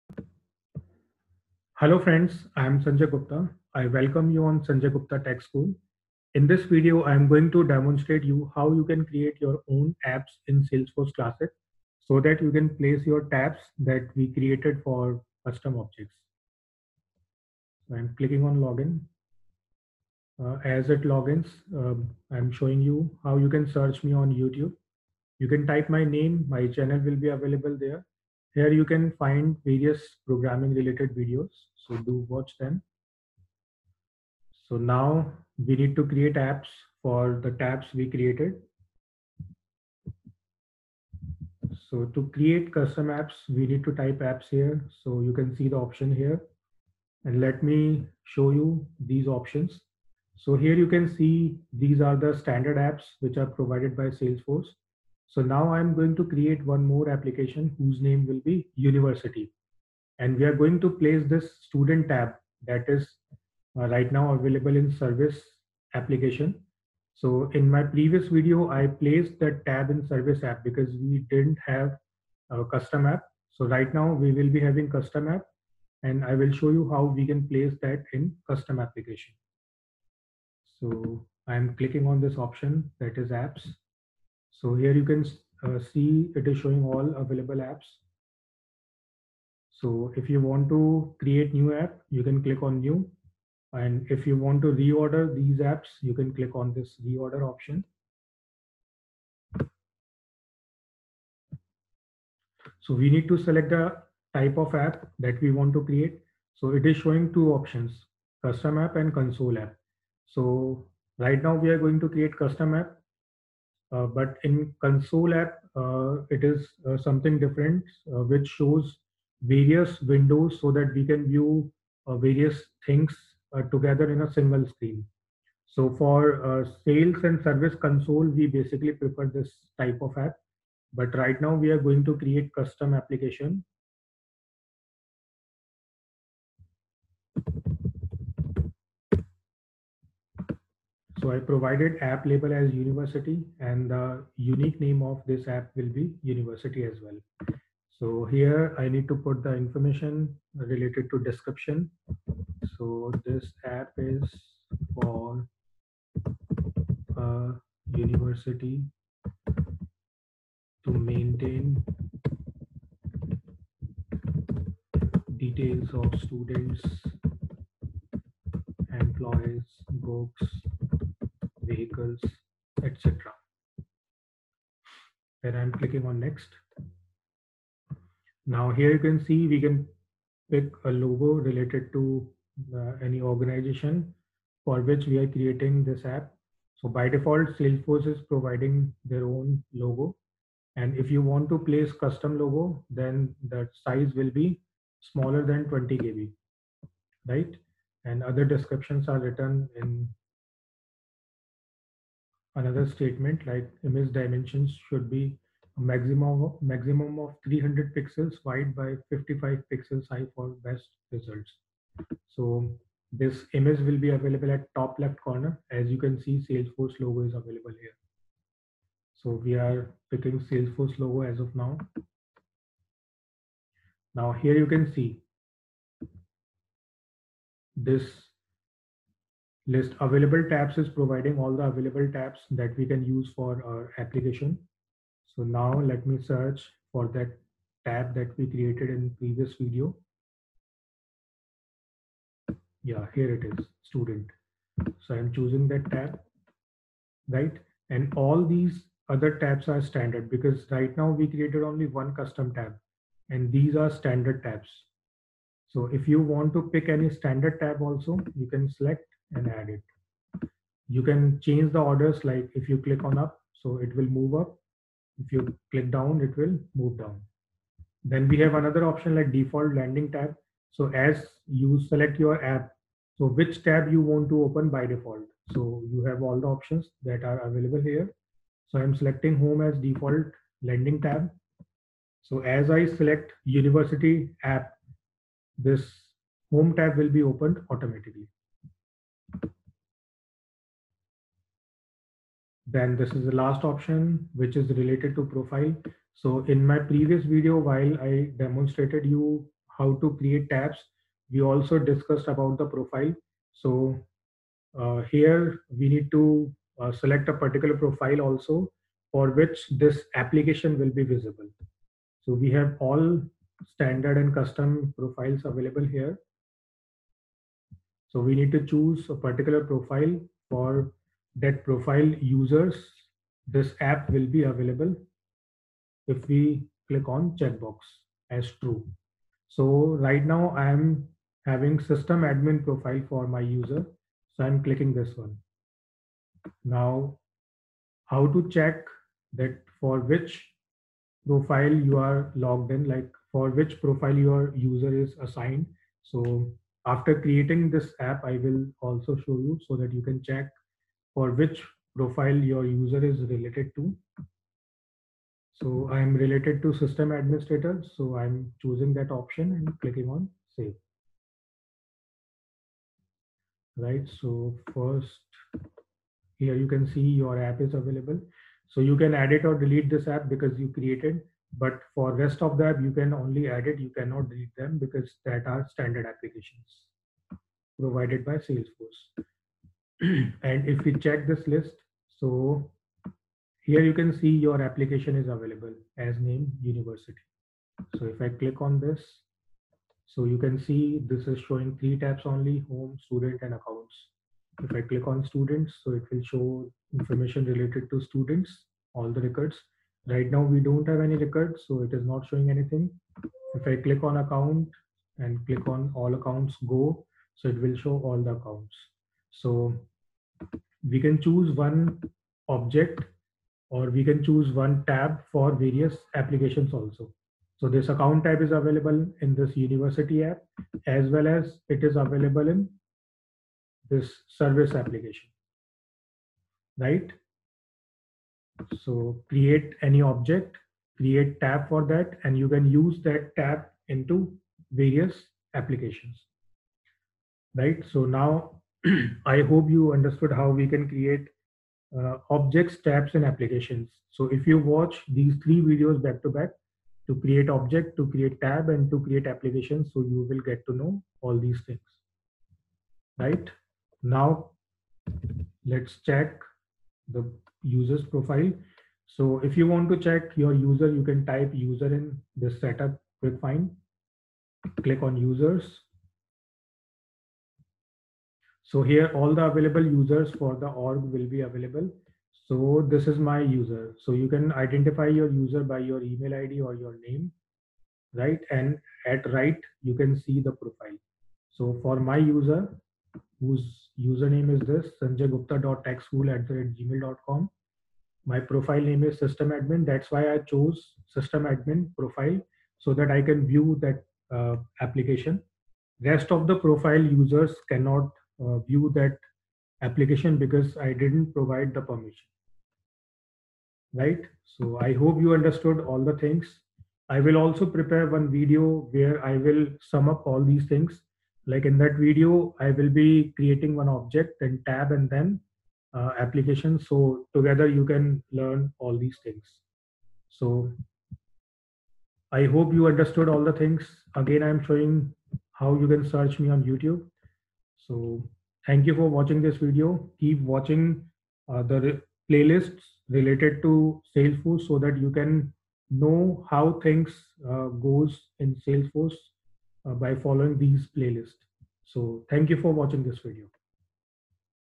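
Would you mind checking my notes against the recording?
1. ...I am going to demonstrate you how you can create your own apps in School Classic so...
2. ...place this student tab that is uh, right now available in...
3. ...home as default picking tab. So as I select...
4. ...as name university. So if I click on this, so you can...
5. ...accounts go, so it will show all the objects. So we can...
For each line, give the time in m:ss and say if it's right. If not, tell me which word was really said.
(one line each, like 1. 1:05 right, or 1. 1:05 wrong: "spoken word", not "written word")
1. 0:07 wrong: "Salesforce", not "School"
2. 1:00 right
3. 4:39 wrong: "landing", not "picking"
4. 6:25 right
5. 6:46 wrong: "accounts", not "objects".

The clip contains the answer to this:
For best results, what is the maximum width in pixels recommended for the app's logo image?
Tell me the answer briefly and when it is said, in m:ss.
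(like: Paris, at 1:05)
300 pixels, at 3:27.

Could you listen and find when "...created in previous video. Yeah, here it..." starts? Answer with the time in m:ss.
3:58.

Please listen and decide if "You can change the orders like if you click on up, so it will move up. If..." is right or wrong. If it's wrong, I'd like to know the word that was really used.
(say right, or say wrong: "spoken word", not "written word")
right.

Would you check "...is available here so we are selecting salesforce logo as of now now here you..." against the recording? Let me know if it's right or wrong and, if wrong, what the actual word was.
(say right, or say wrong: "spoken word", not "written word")
wrong: "picking", not "selecting".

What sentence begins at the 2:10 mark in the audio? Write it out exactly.
But right now we are going to create custom application.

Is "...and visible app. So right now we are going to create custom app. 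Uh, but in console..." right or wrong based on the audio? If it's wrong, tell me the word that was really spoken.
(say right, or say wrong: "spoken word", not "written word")
wrong: "console", not "visible".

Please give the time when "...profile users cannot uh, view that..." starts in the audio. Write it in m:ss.
8:16.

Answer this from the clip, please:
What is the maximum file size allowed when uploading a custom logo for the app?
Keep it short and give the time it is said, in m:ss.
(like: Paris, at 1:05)
20 KB, at 3:15.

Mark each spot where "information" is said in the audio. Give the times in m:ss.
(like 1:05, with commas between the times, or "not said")
2:29, 6:36.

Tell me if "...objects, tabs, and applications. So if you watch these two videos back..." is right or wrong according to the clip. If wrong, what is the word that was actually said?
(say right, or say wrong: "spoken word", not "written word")
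wrong: "three", not "two".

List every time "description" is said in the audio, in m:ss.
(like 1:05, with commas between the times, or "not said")
2:31, 3:18.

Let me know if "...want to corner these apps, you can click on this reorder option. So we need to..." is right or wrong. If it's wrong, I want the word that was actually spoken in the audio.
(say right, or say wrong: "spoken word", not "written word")
wrong: "reorder", not "corner".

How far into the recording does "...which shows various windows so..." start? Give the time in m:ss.
1:58.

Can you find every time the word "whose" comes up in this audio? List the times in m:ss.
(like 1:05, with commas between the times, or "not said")
0:57, 8:03.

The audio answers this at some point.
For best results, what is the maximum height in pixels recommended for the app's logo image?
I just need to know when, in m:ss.
3:29.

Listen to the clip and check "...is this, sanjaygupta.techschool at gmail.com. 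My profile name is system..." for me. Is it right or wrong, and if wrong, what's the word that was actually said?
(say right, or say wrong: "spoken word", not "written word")
right.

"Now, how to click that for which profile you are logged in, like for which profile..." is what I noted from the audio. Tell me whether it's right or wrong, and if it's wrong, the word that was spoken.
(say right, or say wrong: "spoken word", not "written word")
wrong: "check", not "click".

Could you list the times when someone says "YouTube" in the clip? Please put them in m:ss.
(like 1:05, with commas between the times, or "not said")
0:24, 8:46.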